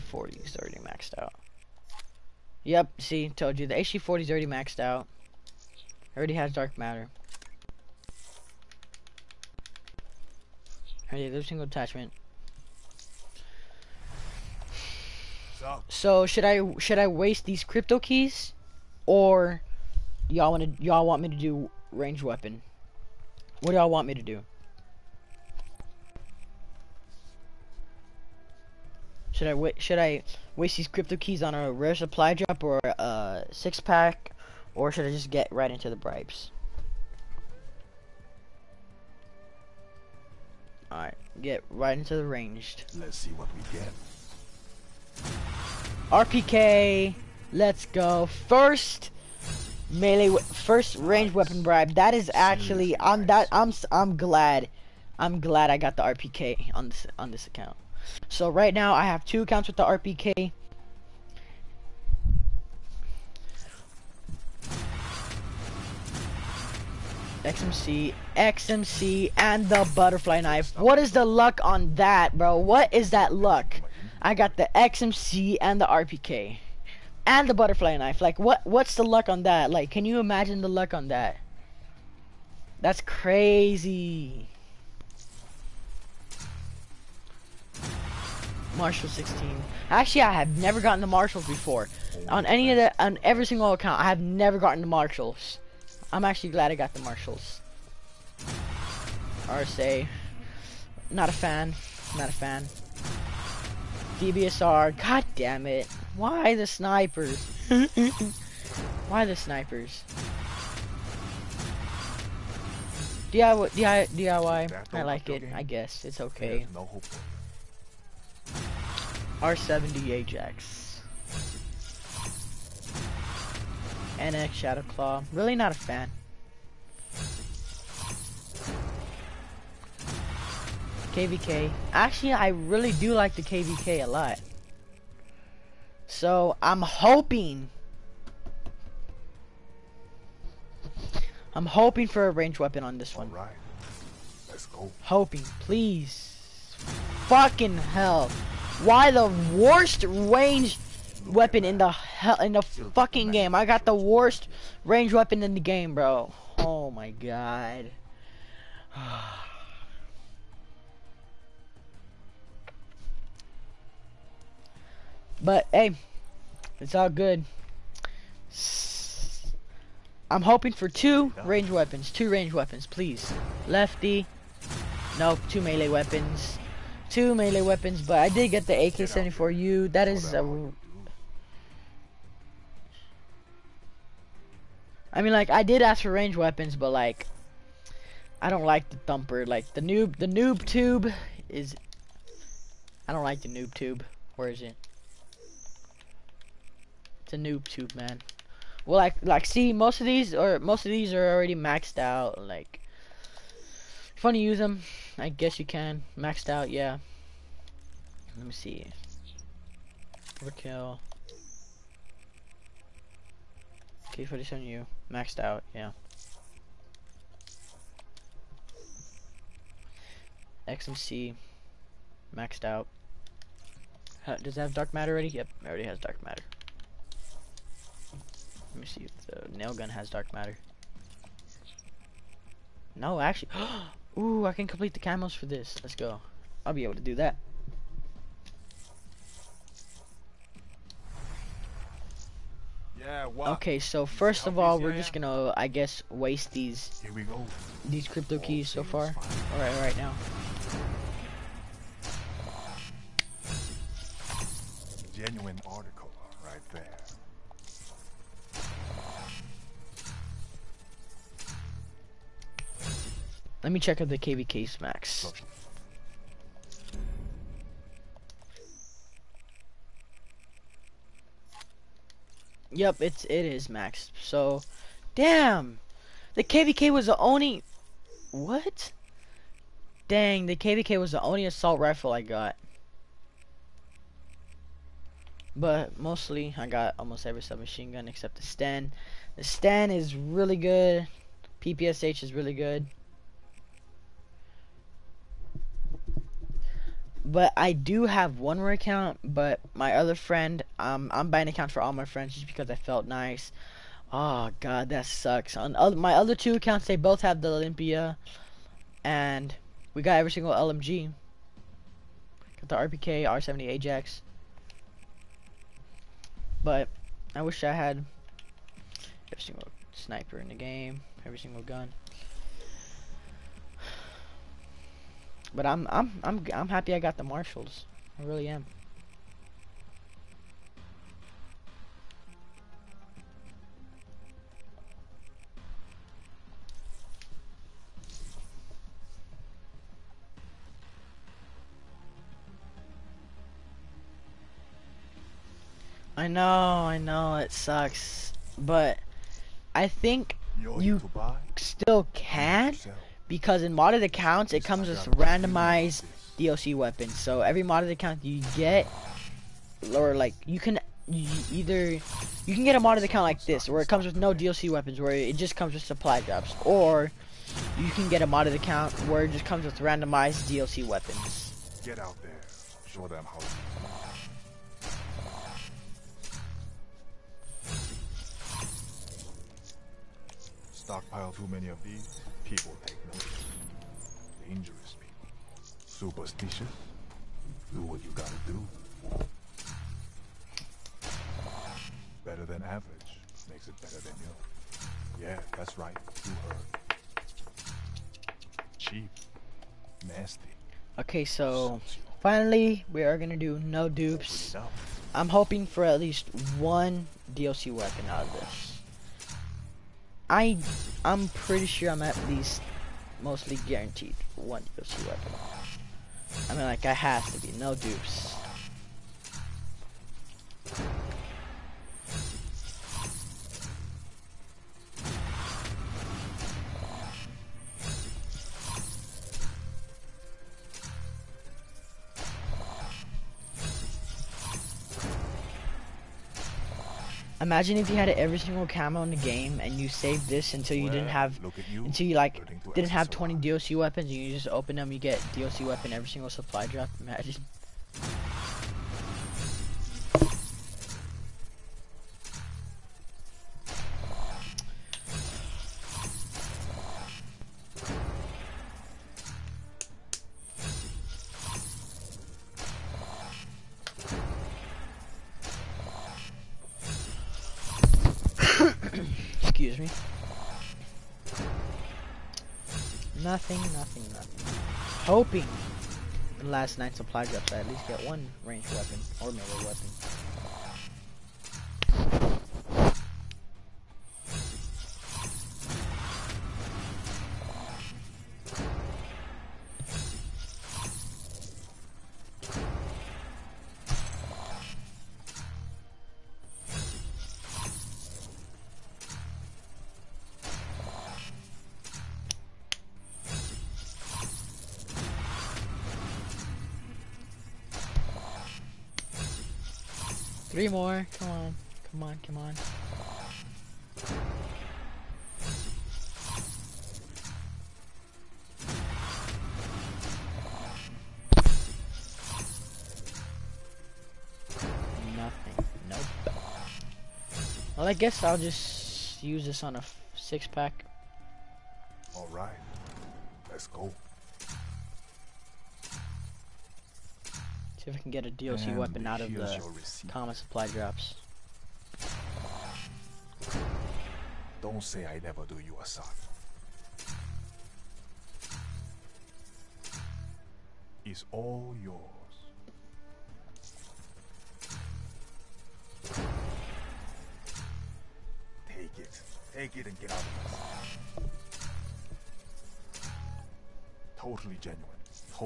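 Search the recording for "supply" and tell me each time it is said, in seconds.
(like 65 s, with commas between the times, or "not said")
31 s, 365 s, 446 s, 476 s, 540 s.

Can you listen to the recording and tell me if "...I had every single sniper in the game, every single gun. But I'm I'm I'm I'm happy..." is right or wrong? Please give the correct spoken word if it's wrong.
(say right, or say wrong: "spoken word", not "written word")
right.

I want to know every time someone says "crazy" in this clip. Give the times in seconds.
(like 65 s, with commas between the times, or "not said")
83 s.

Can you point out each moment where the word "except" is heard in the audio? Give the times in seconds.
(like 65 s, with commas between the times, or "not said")
288 s.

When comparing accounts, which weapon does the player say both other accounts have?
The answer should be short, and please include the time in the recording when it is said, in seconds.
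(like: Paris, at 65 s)
Olympia, at 307 s.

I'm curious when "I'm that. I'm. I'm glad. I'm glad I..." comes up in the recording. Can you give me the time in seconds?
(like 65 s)
52 s.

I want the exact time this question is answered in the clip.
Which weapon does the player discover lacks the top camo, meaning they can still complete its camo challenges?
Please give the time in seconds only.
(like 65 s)
229 s.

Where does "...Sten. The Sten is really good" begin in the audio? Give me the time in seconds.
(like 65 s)
288 s.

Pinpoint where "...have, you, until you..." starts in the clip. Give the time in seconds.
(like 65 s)
441 s.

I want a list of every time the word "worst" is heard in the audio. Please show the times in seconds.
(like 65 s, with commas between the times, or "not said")
149 s, 153 s.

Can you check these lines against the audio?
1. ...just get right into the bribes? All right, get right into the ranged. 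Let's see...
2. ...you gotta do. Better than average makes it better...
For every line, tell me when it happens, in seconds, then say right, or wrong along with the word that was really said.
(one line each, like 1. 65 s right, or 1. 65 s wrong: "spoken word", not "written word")
1. 35 s right
2. 388 s right.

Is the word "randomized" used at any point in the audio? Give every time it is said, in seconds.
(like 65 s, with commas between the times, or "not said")
355 s, 369 s.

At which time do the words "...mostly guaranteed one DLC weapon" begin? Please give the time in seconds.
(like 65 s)
413 s.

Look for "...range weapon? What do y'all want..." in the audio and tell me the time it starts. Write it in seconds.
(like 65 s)
21 s.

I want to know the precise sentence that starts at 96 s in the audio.
I'm actually glad I got the Marshals.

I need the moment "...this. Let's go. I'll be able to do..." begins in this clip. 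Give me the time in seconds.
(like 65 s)
235 s.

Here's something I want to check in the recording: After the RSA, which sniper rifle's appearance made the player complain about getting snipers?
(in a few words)
DBSR.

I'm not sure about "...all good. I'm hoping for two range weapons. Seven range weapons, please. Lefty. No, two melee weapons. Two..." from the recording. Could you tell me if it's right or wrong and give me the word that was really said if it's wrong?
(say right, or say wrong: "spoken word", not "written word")
wrong: "Two", not "Seven".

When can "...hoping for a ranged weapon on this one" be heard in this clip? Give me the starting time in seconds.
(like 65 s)
141 s.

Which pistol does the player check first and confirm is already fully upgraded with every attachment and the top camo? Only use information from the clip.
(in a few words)
HG40.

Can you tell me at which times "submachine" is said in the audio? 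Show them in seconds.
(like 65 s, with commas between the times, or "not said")
287 s.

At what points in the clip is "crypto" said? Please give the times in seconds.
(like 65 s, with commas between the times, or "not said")
17 s, 30 s, 248 s.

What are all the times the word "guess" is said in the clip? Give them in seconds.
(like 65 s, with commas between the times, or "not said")
115 s, 205 s, 245 s, 527 s.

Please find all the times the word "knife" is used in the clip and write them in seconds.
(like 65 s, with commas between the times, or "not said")
70 s, 77 s.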